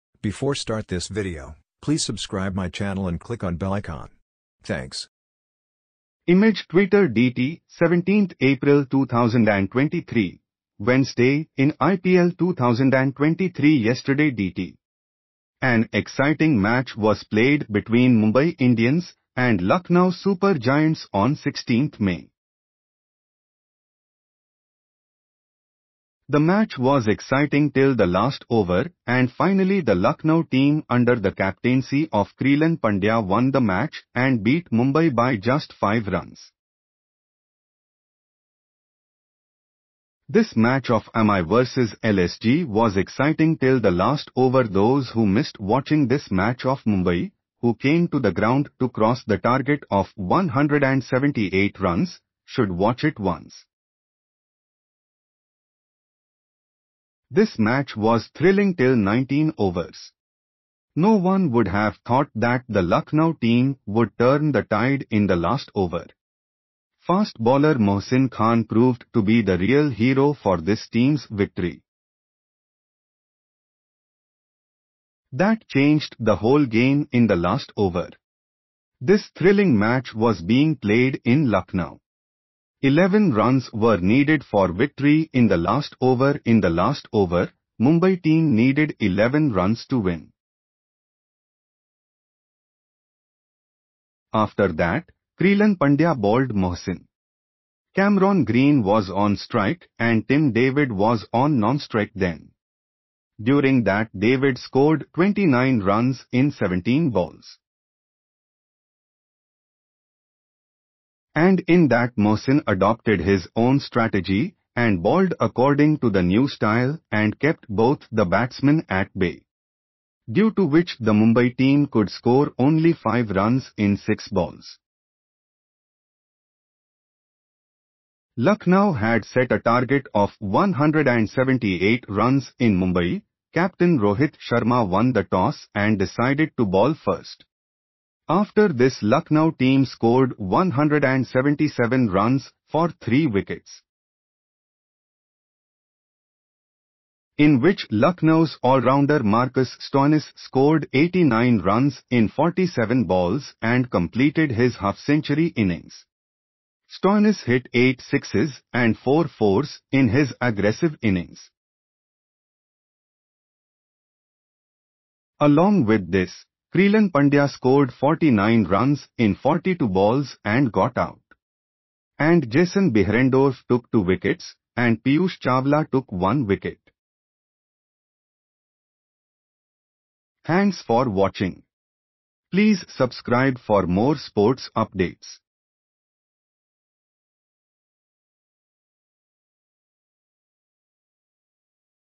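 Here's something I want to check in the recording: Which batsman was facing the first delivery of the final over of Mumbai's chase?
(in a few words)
Cameron Green.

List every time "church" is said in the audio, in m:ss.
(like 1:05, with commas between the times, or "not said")
not said.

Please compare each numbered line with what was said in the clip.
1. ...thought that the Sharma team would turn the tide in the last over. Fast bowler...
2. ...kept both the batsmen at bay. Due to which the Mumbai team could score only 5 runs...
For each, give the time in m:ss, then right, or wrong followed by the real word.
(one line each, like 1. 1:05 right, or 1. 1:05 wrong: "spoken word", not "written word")
1. 1:02 wrong: "Lucknow", not "Sharma"
2. 1:57 right.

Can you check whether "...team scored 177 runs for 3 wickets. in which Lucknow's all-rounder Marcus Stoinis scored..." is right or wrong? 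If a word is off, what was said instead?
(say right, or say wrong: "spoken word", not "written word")
right.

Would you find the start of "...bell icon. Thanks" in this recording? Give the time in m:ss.
0:03.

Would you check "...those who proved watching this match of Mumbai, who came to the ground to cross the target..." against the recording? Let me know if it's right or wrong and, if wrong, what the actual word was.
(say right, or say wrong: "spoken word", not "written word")
wrong: "missed", not "proved".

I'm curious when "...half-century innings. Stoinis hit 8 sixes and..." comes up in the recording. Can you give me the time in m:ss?
2:34.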